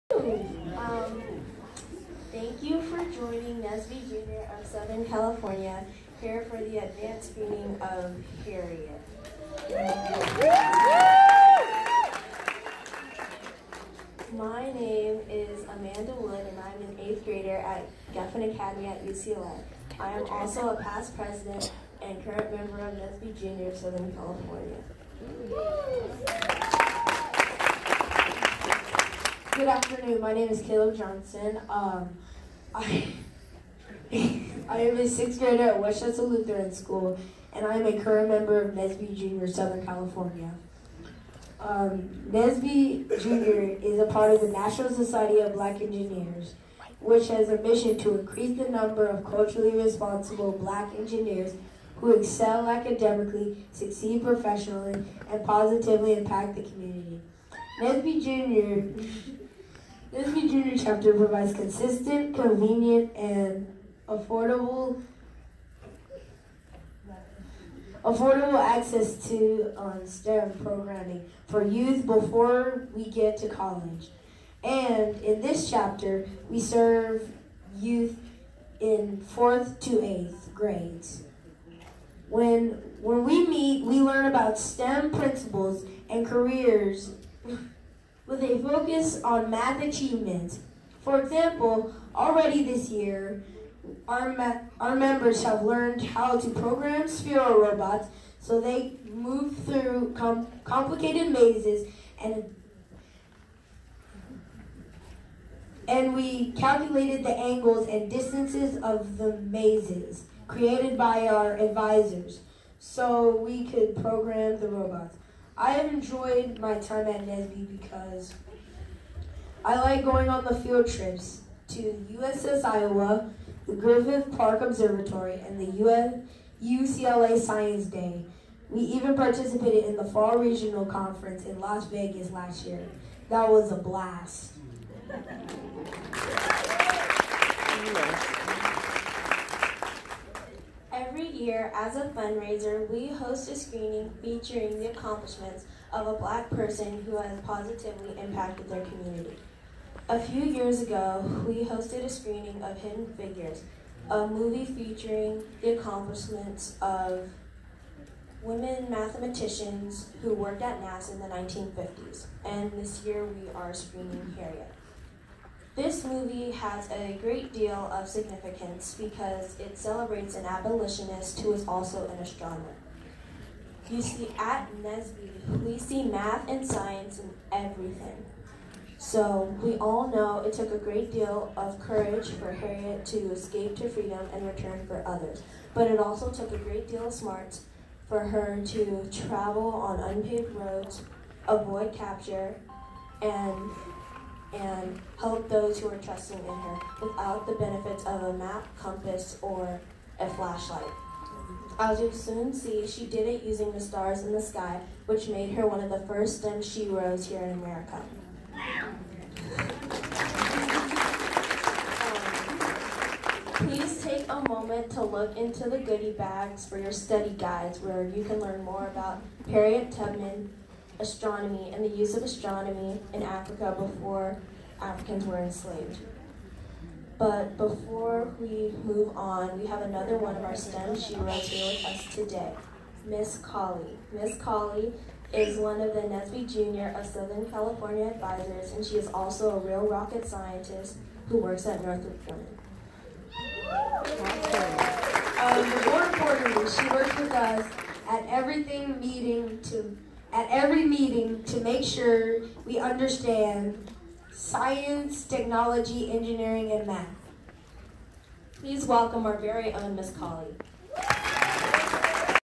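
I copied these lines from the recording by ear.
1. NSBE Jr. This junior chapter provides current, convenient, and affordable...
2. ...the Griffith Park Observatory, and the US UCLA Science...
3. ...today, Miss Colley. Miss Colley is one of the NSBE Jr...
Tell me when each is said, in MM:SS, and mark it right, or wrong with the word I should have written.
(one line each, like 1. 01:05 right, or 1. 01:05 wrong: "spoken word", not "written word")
1. 00:57 wrong: "consistent", not "current"
2. 02:03 right
3. 03:52 right.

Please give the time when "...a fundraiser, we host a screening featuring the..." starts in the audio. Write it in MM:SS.
02:21.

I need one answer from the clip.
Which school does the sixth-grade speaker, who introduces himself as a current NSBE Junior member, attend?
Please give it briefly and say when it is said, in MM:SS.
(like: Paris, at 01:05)
Westchester Lutheran School, at 00:35.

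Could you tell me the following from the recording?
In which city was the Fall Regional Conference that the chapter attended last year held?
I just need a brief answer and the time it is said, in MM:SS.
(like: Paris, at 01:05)
Las Vegas, at 02:11.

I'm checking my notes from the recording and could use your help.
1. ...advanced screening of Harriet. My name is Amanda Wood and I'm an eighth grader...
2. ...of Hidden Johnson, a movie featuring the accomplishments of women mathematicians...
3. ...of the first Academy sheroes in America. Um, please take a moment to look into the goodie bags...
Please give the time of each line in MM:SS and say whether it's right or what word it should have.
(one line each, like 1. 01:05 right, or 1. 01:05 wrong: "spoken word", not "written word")
1. 00:06 right
2. 02:32 wrong: "Figures", not "Johnson"
3. 03:25 wrong: "STEM", not "Academy".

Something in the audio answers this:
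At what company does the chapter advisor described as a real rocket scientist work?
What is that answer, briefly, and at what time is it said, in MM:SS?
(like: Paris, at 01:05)
Northrop Grumman, at 04:01.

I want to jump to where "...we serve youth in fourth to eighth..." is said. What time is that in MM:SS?
01:16.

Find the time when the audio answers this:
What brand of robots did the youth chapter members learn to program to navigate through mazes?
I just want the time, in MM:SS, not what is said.
01:37.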